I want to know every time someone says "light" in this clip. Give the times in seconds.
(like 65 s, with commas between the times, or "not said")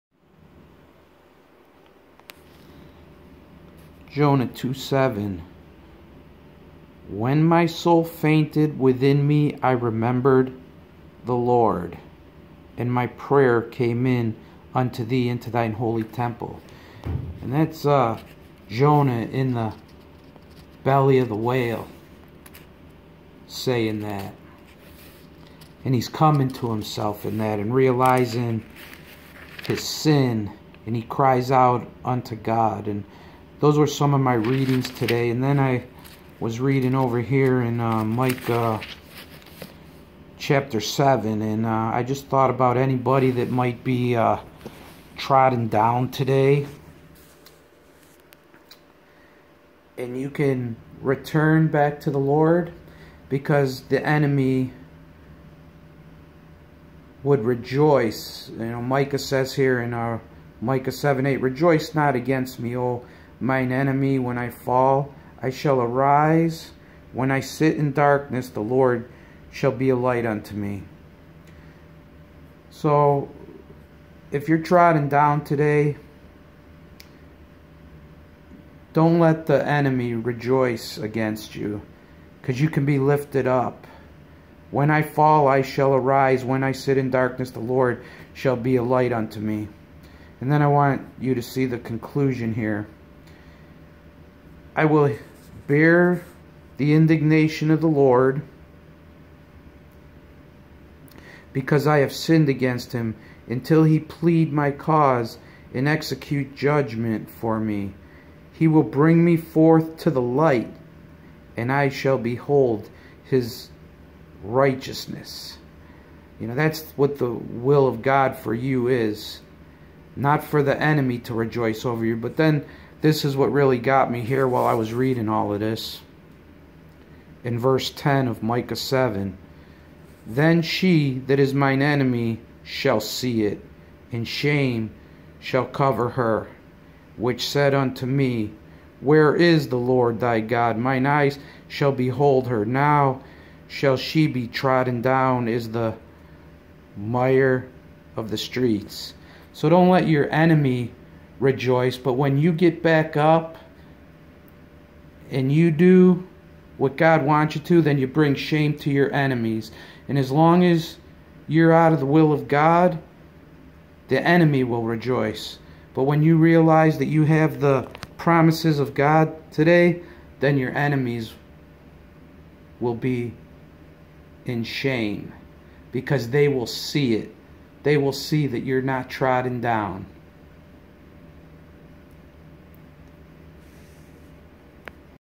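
69 s, 88 s, 110 s.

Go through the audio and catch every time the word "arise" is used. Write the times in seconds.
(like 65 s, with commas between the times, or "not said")
65 s, 85 s.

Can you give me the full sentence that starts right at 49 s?
And you can return back to the Lord because the enemy would rejoice.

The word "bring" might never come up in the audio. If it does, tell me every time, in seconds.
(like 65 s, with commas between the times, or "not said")
108 s, 158 s.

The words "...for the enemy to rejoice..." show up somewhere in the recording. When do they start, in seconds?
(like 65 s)
120 s.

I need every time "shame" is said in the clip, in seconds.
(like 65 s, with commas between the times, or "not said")
134 s, 158 s, 174 s.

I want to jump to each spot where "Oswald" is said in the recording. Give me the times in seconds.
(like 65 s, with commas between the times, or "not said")
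not said.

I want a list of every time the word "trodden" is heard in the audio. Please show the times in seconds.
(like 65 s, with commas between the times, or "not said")
45 s, 74 s, 144 s, 179 s.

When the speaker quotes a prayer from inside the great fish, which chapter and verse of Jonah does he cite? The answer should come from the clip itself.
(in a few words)
Jonah 2:7.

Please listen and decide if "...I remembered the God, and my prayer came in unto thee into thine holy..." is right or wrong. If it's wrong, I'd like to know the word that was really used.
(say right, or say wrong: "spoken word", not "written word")
wrong: "Lord", not "God".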